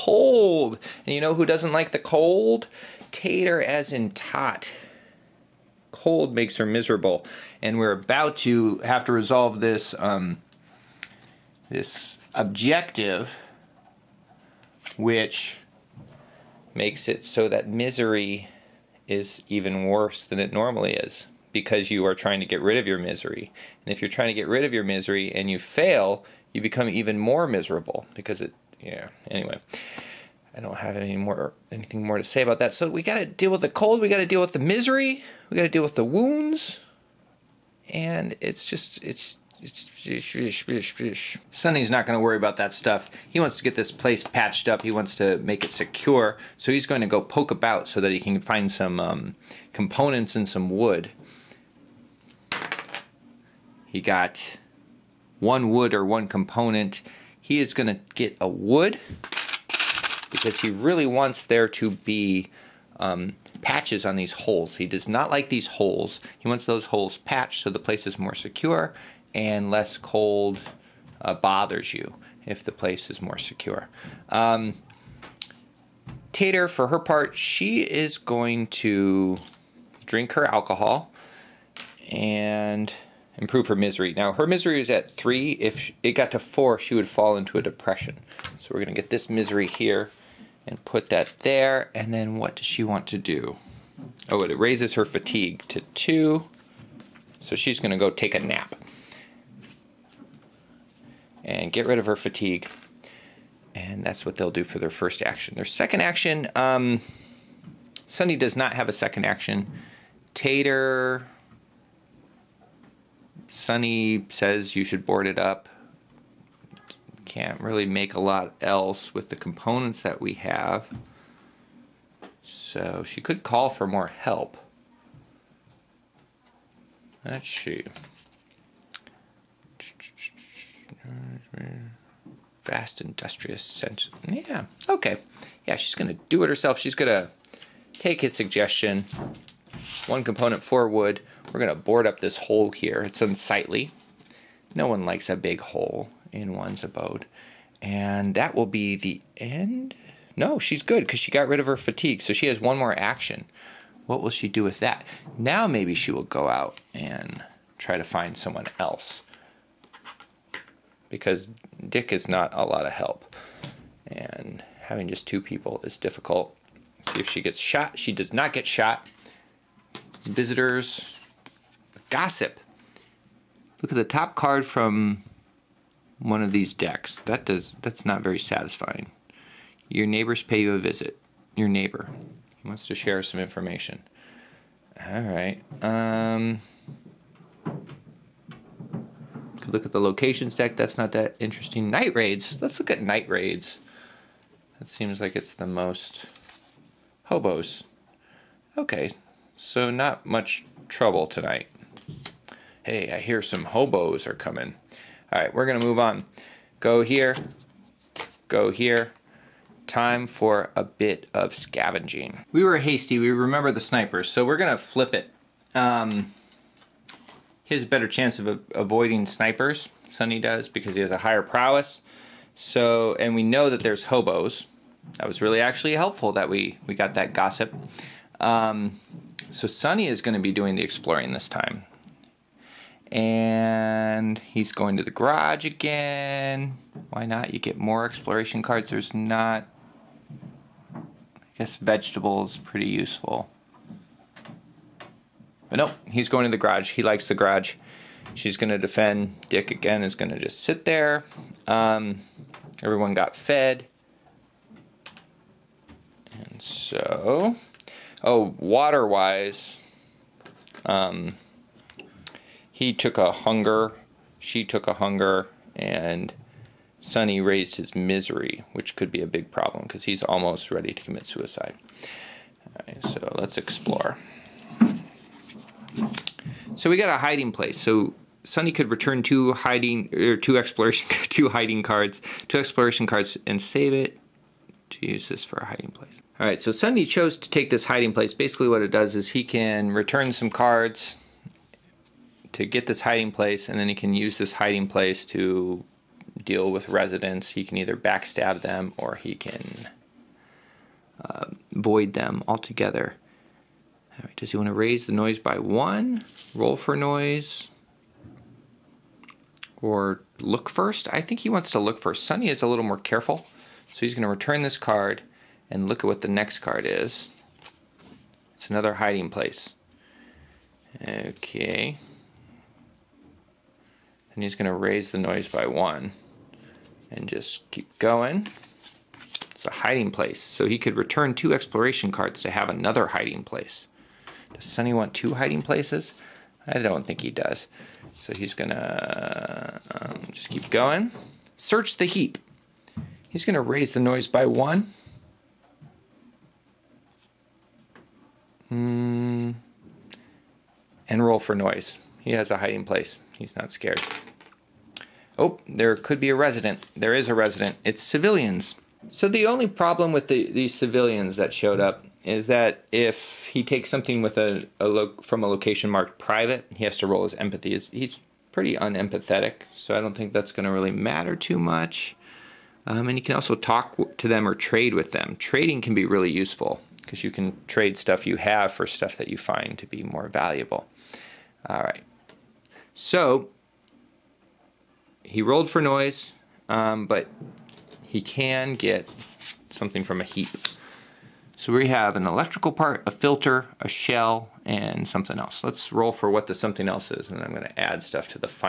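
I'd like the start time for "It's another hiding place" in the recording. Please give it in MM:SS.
05:18.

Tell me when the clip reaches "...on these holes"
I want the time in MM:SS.
01:04.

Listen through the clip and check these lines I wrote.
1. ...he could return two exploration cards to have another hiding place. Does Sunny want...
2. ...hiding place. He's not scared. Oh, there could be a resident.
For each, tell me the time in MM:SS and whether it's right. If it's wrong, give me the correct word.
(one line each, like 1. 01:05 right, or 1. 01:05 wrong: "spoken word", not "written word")
1. 05:30 right
2. 05:52 right.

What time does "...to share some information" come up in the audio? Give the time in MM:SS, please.
03:02.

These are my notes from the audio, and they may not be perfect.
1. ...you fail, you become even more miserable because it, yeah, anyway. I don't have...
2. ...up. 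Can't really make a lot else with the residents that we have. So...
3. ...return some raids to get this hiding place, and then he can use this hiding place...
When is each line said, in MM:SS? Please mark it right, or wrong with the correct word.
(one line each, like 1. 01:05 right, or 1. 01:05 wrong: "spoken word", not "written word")
1. 00:25 right
2. 01:55 wrong: "components", not "residents"
3. 04:49 wrong: "cards", not "raids".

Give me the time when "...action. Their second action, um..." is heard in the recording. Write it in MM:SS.
01:45.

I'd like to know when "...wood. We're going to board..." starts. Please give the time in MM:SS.
02:20.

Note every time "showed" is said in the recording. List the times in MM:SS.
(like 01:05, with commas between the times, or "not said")
06:01.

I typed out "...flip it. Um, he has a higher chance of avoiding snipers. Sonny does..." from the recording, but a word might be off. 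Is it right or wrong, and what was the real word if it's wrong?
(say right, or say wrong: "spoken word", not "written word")
wrong: "better", not "higher".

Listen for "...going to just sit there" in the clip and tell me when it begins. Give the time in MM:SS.
04:10.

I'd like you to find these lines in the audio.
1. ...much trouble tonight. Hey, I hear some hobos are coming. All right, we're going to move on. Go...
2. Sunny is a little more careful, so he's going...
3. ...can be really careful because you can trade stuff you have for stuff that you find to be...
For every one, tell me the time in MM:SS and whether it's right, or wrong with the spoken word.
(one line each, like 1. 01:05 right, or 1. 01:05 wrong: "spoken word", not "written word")
1. 03:20 right
2. 05:12 right
3. 06:15 wrong: "useful", not "careful".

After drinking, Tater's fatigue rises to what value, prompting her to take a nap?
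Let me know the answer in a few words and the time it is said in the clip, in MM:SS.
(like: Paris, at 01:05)
2, at 01:34.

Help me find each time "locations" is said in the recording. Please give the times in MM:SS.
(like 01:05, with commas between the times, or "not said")
03:10, 06:05.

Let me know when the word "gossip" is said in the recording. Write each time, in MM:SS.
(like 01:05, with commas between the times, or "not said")
02:52, 03:47.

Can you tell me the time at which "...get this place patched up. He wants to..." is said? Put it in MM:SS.
00:43.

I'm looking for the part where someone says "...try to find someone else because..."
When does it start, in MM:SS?
02:37.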